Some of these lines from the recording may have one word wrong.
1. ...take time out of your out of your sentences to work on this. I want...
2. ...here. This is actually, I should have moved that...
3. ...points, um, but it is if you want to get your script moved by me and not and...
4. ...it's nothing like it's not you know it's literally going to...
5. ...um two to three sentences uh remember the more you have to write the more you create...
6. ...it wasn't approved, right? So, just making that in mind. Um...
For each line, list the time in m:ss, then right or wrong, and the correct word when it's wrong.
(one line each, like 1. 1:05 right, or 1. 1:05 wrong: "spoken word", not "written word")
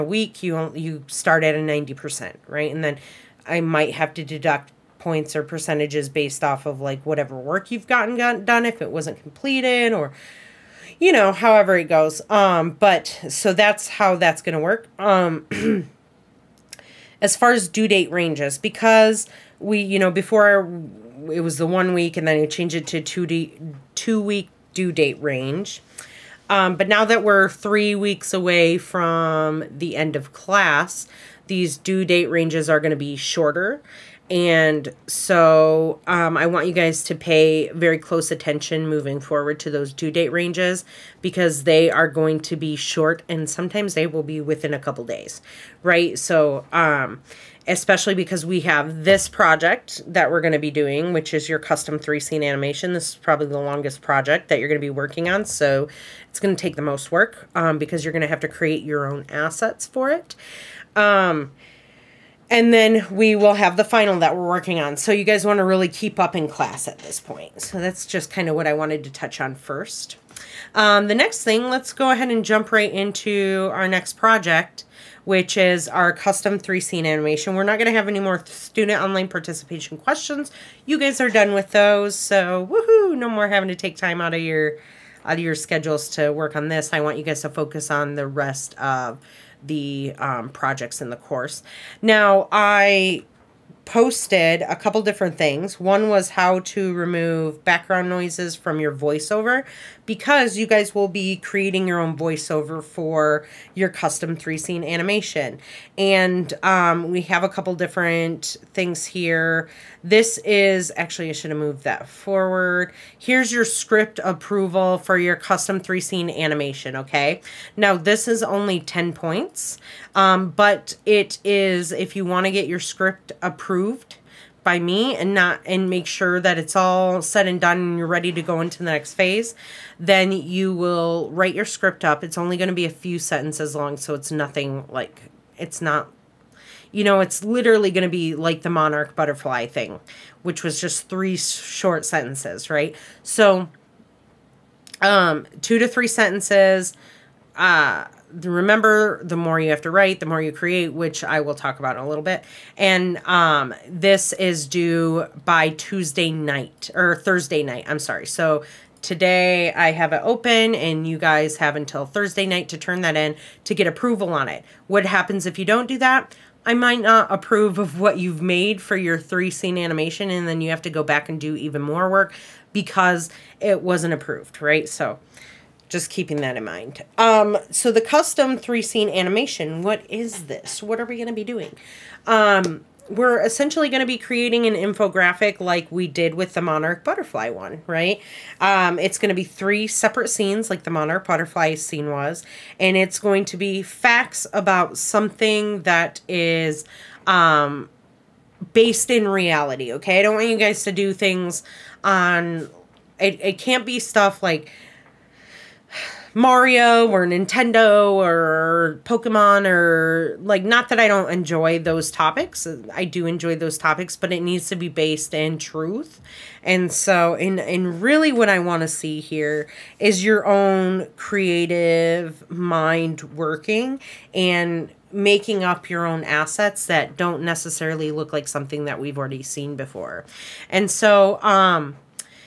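1. 1:23 wrong: "schedules", not "sentences"
2. 1:49 right
3. 1:59 wrong: "approved", not "moved"
4. 2:14 right
5. 2:25 right
6. 2:53 wrong: "keeping", not "making".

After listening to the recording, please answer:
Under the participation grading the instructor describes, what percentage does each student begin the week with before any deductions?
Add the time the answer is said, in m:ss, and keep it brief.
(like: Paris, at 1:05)
90%, at 0:01.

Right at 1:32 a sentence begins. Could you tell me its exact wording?
Now, I posted a couple different things.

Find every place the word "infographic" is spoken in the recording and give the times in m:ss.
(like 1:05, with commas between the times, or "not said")
3:04.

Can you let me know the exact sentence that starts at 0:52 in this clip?
This is probably the longest project that you're going to be working on.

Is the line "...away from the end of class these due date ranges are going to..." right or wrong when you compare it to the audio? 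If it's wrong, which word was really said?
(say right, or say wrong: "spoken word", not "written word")
right.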